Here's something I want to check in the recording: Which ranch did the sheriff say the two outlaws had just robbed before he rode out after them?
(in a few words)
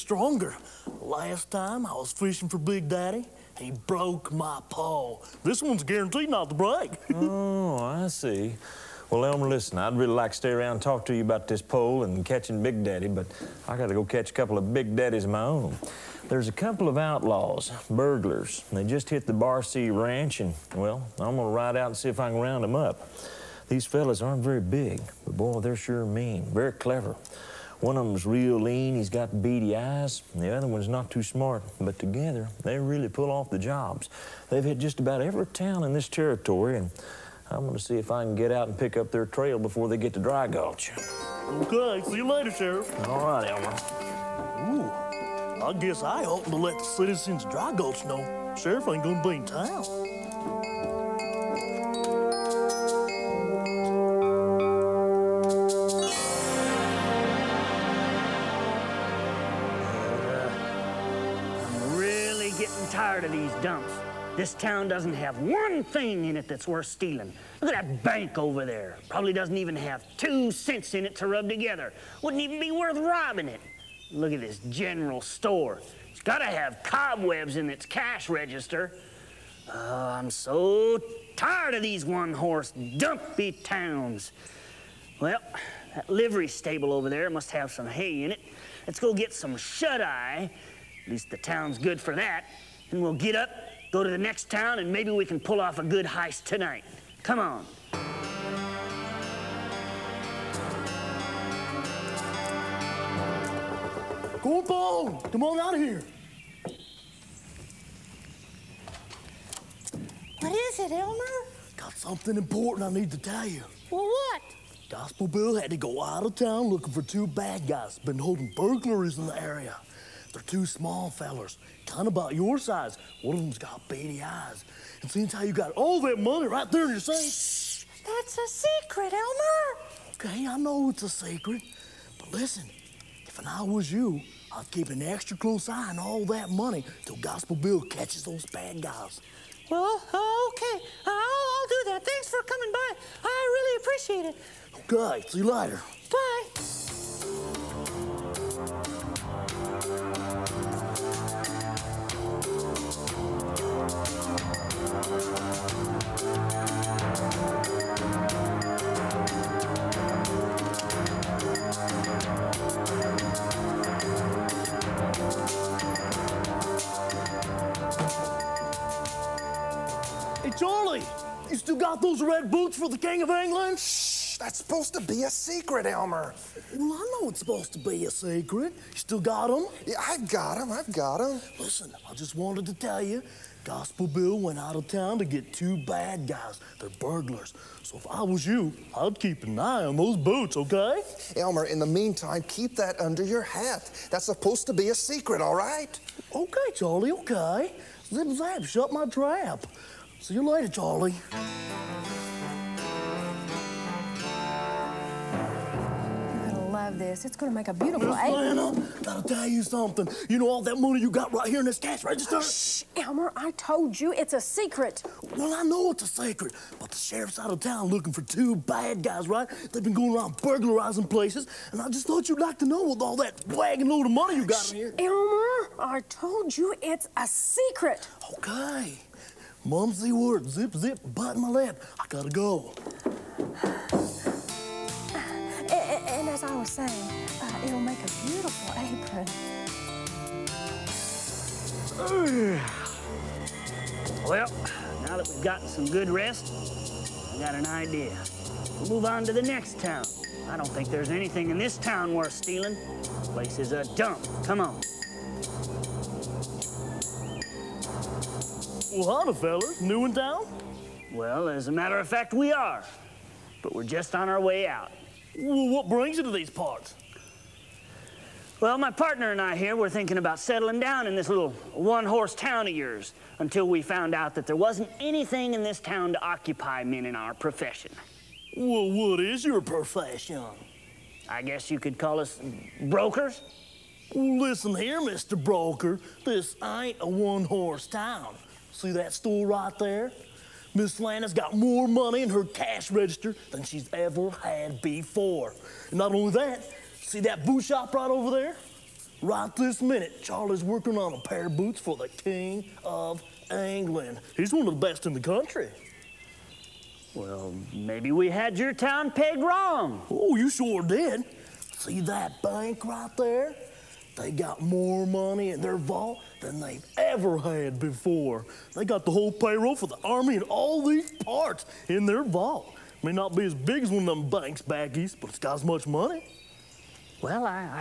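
Barcee Ranch.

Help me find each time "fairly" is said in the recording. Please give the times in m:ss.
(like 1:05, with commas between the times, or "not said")
not said.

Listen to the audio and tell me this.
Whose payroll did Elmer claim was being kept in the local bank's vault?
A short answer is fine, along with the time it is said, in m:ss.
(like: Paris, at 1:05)
The Army, at 5:19.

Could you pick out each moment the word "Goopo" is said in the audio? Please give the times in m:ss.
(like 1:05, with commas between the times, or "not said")
1:44.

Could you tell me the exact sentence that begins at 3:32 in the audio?
Shh, Elmer, I told you it's a secret.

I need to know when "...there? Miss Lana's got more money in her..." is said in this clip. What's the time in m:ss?
4:49.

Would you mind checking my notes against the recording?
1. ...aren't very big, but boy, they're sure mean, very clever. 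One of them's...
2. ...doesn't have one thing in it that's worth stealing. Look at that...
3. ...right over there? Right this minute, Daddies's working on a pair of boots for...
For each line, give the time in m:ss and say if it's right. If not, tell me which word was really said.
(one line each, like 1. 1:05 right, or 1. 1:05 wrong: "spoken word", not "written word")
1. 0:24 right
2. 1:04 right
3. 4:57 wrong: "Charlie", not "Daddies".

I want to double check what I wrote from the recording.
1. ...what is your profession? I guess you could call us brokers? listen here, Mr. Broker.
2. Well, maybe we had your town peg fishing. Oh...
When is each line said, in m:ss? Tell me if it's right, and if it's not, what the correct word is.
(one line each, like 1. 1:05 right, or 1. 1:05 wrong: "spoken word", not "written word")
1. 4:38 right
2. 5:07 wrong: "wrong", not "fishing".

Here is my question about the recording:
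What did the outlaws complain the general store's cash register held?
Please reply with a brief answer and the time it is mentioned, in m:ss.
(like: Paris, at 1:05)
Cobwebs, at 1:16.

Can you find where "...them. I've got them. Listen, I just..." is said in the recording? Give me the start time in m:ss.
3:00.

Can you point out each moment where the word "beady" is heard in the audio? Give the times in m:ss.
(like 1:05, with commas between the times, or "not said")
0:29, 2:03.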